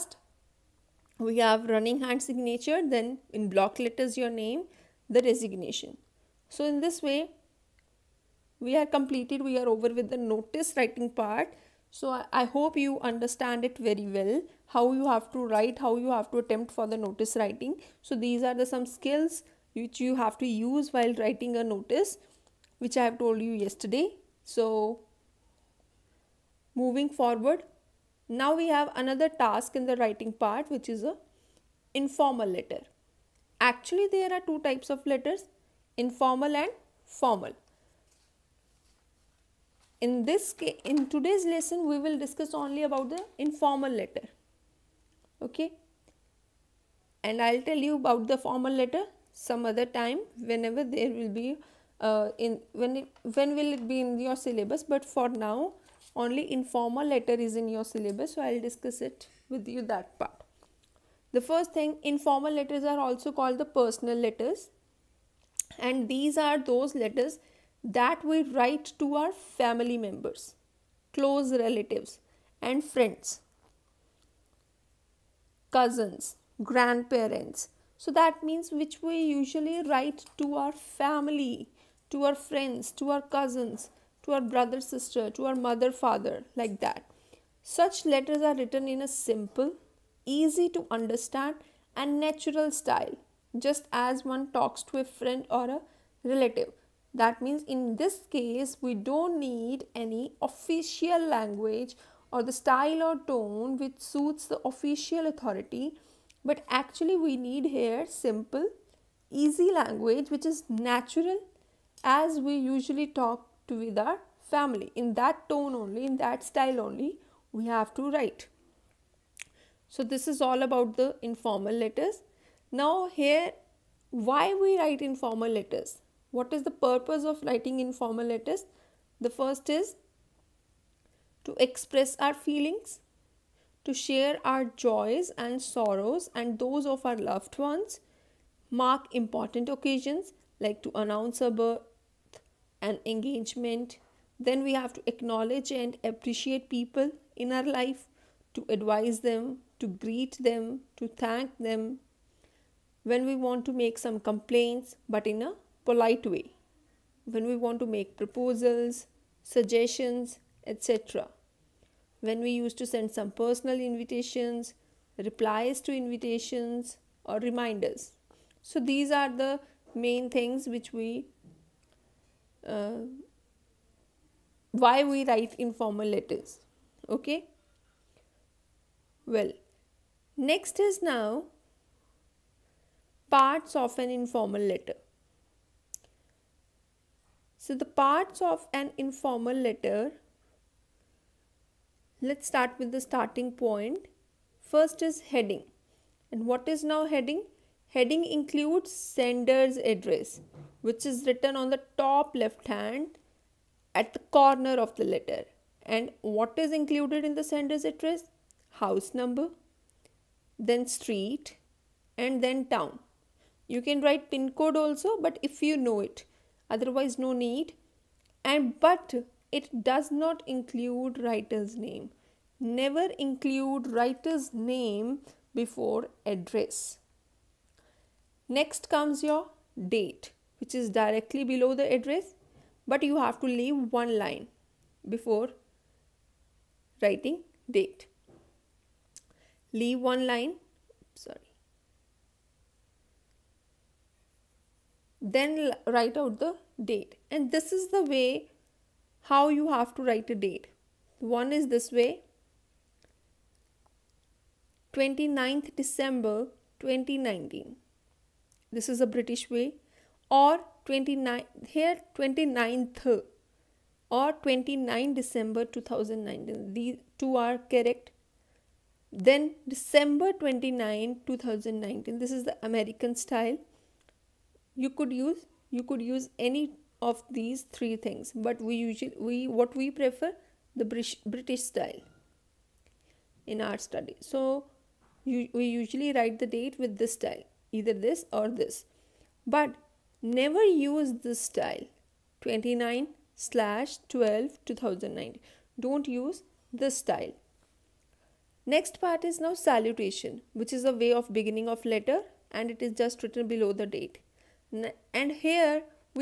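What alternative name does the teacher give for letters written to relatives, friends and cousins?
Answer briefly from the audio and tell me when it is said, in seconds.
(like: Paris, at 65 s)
personal letters, at 63 s.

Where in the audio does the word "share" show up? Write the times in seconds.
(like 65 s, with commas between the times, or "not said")
133 s.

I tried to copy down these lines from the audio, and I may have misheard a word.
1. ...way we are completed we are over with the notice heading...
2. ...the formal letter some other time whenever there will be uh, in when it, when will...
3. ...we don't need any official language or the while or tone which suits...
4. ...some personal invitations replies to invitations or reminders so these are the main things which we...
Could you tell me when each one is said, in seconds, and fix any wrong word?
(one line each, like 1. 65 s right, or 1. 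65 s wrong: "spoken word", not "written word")
1. 7 s wrong: "writing", not "heading"
2. 48 s right
3. 98 s wrong: "style", not "while"
4. 163 s right.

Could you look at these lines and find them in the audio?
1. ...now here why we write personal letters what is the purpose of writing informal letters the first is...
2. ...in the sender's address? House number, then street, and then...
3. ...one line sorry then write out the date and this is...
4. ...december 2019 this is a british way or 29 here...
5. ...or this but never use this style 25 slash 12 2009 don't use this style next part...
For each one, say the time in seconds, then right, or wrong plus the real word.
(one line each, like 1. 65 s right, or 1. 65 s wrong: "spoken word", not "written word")
1. 122 s wrong: "informal", not "personal"
2. 207 s right
3. 240 s right
4. 255 s right
5. 288 s wrong: "29", not "25".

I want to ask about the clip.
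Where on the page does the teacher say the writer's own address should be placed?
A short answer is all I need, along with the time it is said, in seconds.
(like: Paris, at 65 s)
top left hand, at 201 s.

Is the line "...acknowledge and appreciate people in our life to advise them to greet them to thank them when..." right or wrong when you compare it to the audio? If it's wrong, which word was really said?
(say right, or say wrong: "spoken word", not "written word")
right.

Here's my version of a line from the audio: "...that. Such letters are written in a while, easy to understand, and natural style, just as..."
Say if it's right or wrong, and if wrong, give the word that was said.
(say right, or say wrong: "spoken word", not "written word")
wrong: "simple", not "while".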